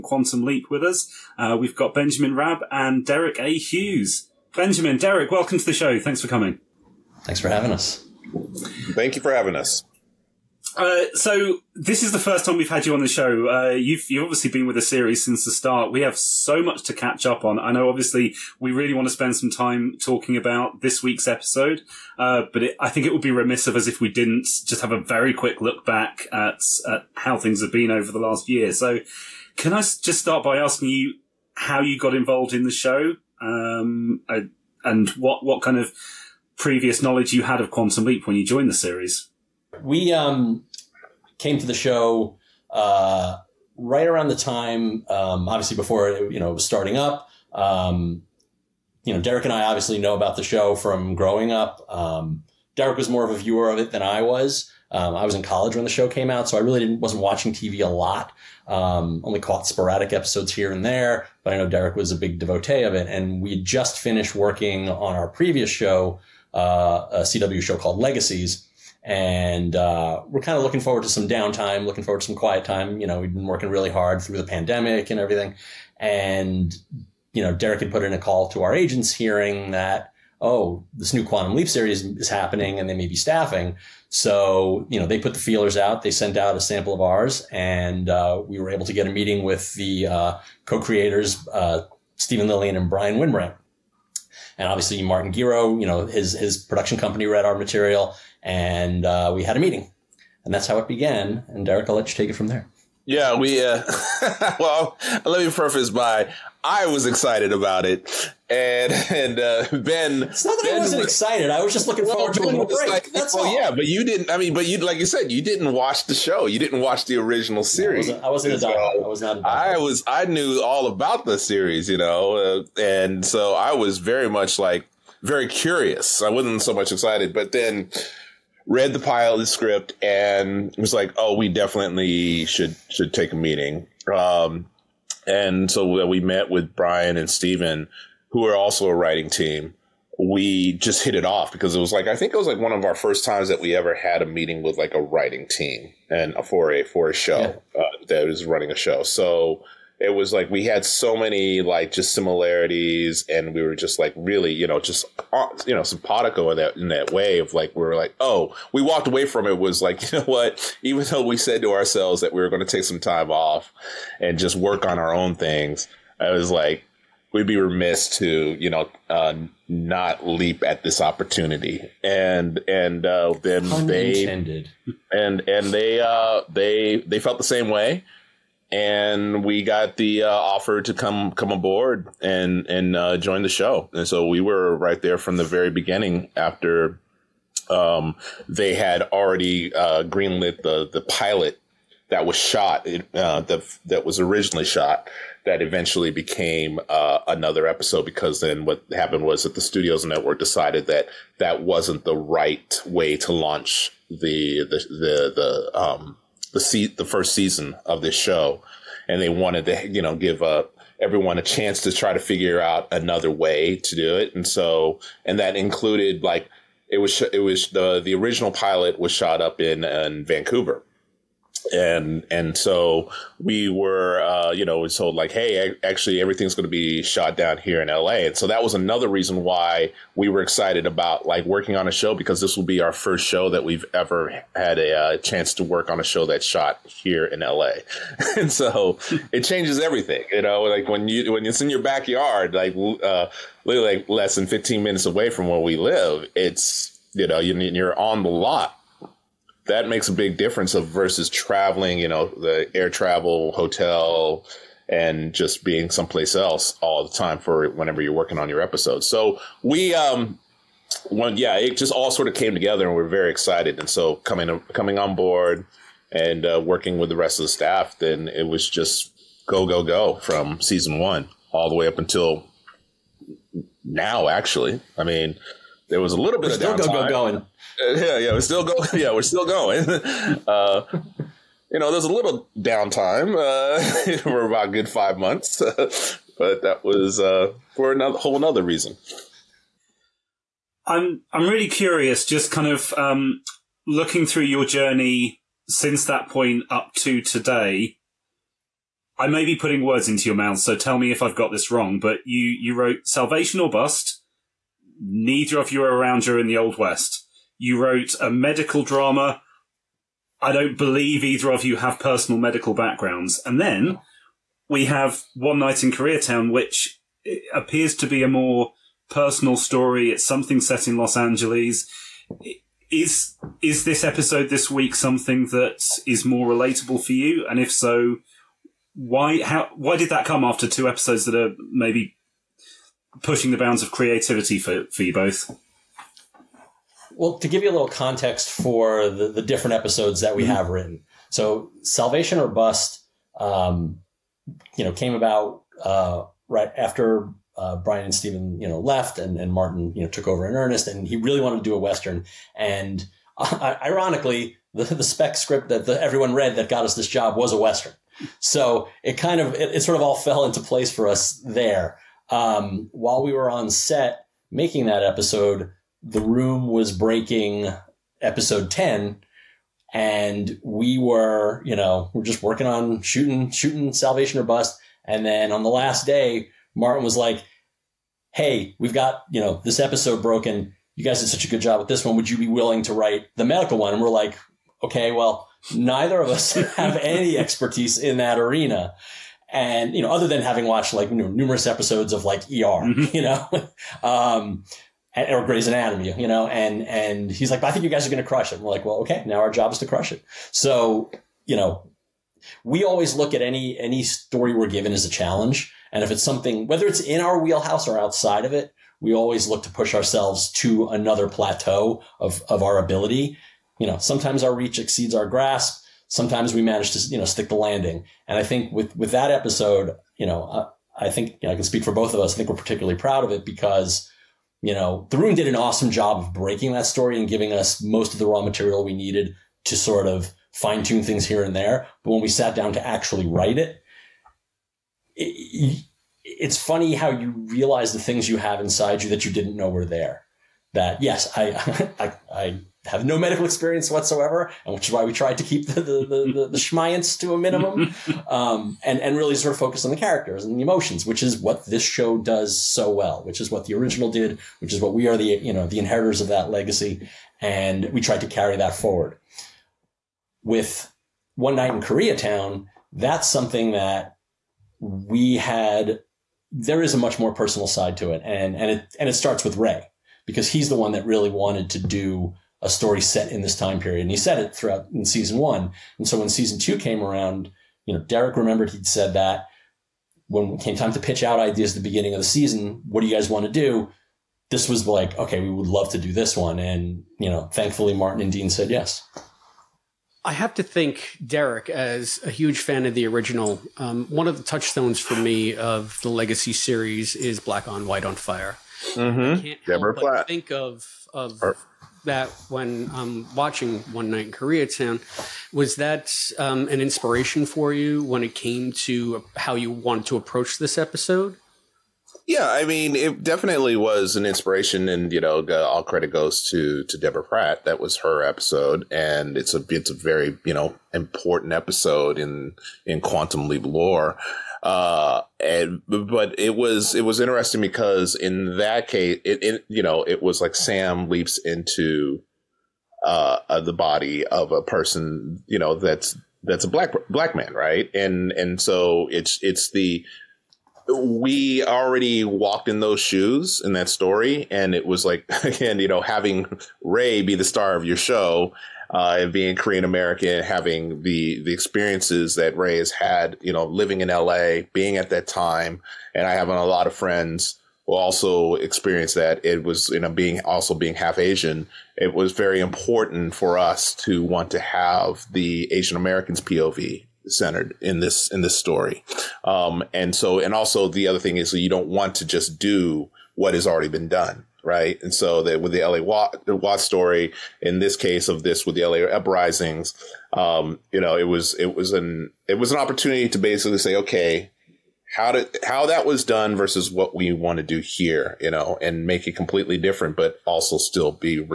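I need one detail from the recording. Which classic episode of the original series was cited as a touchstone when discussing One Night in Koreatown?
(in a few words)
Black on White on Fire.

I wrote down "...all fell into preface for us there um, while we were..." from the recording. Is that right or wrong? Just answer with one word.
wrong.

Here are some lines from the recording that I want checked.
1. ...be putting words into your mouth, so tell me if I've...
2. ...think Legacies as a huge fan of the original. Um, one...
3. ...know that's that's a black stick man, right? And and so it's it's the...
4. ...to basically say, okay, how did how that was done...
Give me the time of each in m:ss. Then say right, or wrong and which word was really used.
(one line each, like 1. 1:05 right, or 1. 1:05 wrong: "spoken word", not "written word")
1. 4:59 right
2. 8:10 wrong: "Deric", not "Legacies"
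3. 8:55 wrong: "black", not "stick"
4. 9:43 right.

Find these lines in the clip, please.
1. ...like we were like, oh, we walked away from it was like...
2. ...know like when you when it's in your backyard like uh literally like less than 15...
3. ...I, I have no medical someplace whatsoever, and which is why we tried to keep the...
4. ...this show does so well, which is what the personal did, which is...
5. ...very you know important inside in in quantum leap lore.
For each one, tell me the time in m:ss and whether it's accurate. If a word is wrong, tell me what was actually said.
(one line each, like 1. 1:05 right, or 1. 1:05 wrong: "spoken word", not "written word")
1. 2:37 right
2. 4:00 right
3. 7:21 wrong: "experience", not "someplace"
4. 7:31 wrong: "original", not "personal"
5. 8:39 wrong: "episode", not "inside".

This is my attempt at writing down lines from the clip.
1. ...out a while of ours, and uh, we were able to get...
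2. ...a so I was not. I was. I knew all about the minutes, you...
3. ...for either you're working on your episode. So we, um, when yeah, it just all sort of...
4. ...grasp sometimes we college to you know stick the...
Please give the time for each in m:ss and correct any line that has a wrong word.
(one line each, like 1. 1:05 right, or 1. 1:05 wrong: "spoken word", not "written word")
1. 1:26 wrong: "sample", not "while"
2. 1:58 wrong: "series", not "minutes"
3. 4:17 wrong: "whenever", not "either"
4. 6:55 wrong: "manage", not "college".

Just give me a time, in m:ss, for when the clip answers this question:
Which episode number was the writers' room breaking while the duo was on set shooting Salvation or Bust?
6:08.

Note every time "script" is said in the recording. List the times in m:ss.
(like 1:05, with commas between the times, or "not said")
2:09, 5:55.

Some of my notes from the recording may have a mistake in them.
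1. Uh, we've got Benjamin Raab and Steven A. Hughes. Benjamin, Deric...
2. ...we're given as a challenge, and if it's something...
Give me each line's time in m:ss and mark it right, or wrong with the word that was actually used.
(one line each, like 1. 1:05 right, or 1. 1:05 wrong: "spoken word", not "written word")
1. 0:01 wrong: "Deric", not "Steven"
2. 6:44 right.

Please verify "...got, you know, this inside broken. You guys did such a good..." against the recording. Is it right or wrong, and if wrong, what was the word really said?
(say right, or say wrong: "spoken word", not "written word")
wrong: "episode", not "inside".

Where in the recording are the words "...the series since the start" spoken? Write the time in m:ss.
0:14.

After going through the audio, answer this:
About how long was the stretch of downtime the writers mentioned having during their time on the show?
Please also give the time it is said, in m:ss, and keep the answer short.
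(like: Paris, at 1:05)
five months, at 4:44.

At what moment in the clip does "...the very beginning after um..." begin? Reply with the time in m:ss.
3:05.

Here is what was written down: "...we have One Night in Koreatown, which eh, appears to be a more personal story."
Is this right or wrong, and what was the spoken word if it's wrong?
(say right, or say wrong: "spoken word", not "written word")
right.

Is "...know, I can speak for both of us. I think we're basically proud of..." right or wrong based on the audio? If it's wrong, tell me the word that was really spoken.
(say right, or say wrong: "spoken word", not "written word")
wrong: "particularly", not "basically".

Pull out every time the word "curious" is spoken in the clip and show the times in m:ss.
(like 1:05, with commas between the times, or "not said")
2:05, 4:51.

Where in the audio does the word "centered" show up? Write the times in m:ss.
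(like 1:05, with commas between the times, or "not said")
9:27.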